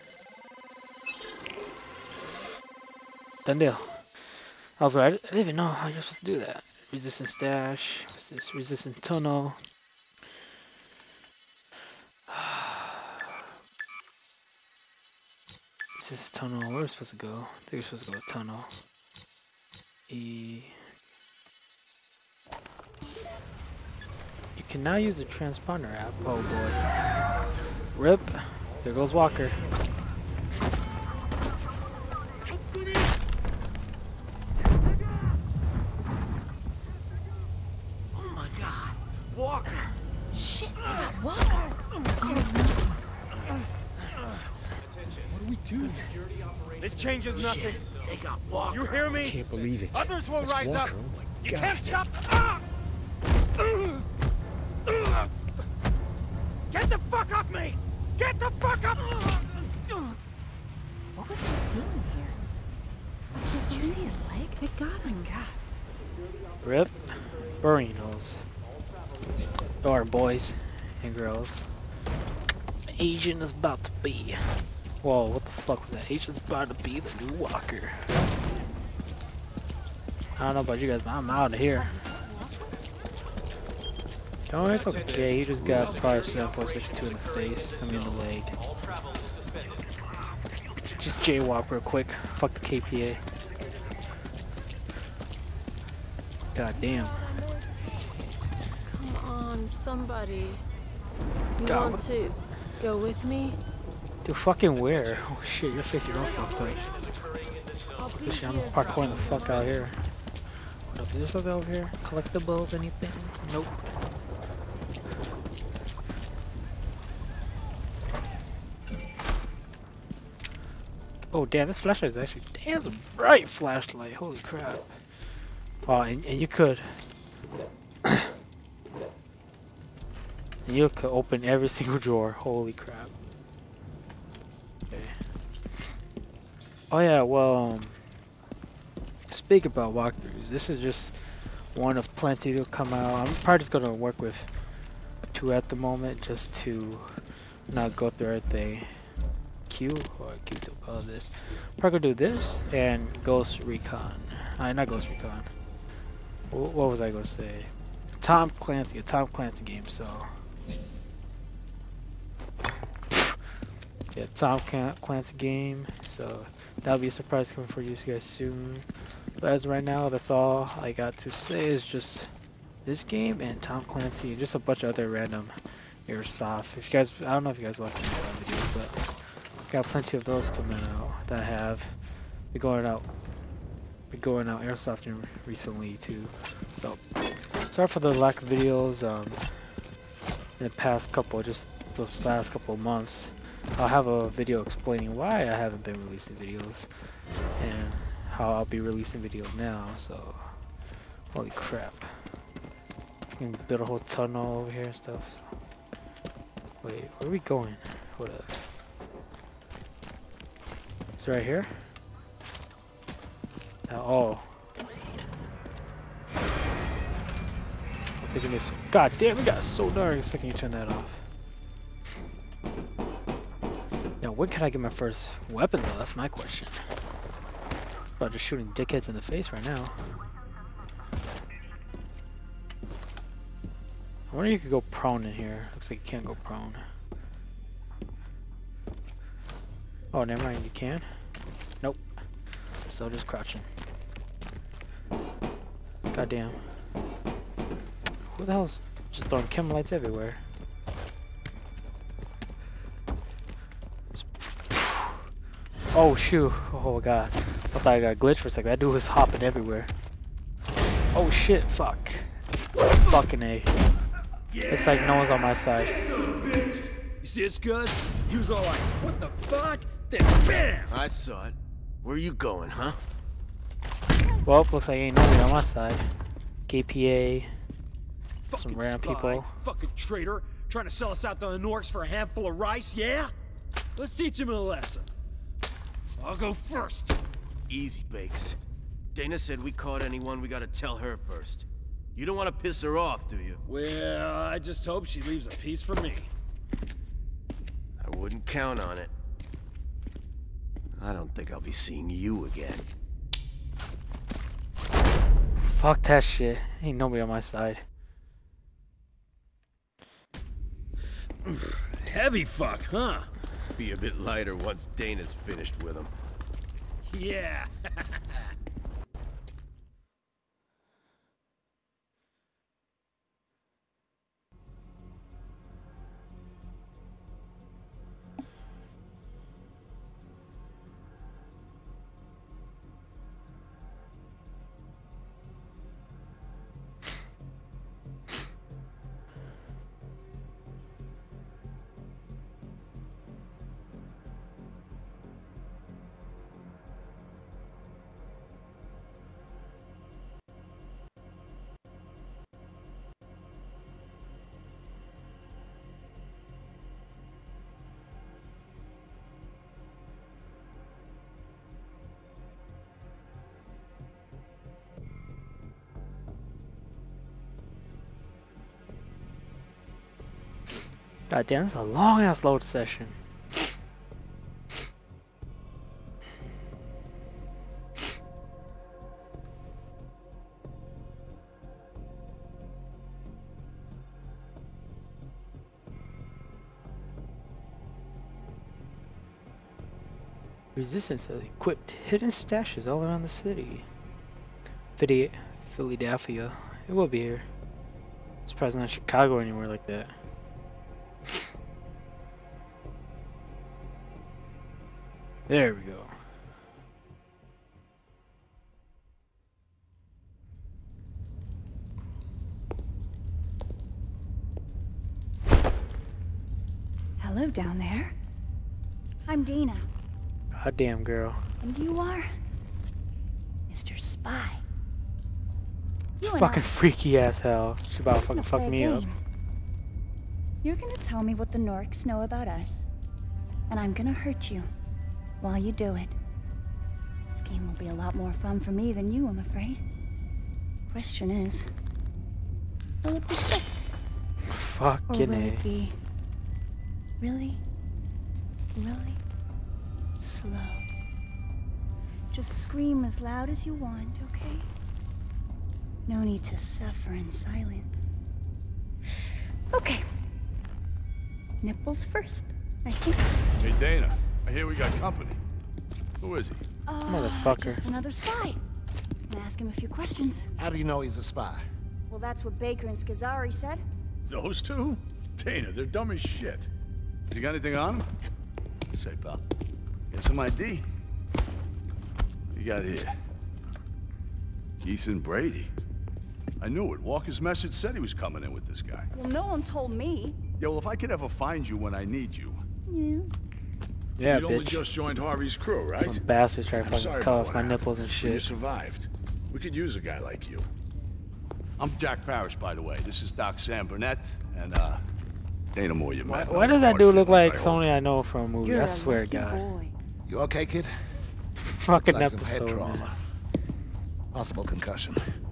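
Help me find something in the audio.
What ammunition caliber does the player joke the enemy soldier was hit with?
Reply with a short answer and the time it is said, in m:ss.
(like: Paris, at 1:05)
7.62, at 1:26.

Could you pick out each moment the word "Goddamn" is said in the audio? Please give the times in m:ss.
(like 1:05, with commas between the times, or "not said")
4:06, 7:00.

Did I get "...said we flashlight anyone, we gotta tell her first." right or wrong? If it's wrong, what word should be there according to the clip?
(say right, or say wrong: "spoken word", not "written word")
wrong: "caught", not "flashlight".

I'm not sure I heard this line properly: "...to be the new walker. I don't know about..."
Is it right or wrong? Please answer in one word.
right.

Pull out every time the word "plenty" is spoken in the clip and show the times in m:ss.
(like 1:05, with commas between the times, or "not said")
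2:22, 2:59.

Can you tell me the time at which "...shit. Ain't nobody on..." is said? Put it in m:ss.
5:06.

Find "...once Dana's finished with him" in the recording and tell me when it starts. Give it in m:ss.
5:14.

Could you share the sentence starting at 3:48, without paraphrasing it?
About just shooting dickheads in the face right now.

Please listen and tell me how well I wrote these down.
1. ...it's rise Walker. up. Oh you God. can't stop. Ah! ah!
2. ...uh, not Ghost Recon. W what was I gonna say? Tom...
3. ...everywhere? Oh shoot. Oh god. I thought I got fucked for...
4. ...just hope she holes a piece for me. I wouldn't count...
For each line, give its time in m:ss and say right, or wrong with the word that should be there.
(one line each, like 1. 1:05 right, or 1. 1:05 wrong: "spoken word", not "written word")
1. 0:50 right
2. 2:34 right
3. 4:09 wrong: "glitched", not "fucked"
4. 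4:54 wrong: "leaves", not "holes".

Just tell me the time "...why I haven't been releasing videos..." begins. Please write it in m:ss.
3:15.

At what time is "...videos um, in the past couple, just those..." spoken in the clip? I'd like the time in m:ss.
3:08.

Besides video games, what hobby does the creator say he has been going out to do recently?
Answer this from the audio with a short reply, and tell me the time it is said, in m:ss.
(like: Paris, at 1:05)
Airsoft, at 3:04.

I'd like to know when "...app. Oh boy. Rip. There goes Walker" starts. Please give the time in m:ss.
0:25.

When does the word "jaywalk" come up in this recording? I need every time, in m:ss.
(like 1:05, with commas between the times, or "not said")
1:31.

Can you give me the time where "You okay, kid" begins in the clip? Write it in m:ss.
8:30.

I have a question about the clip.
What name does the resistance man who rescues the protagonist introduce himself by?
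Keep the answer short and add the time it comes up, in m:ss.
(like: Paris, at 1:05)
Jack Parrish, at 8:21.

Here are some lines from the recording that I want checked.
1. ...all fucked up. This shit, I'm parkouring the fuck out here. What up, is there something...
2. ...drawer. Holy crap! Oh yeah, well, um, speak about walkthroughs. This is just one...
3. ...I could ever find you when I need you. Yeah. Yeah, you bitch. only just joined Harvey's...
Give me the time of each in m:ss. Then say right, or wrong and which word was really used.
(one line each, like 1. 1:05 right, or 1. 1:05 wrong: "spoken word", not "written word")
1. 1:46 right
2. 2:11 right
3. 8:10 right.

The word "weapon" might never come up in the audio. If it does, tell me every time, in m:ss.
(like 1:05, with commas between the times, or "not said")
3:45.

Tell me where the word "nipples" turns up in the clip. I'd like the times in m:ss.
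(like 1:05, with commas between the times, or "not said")
7:41, 8:17.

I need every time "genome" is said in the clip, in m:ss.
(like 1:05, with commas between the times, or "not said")
not said.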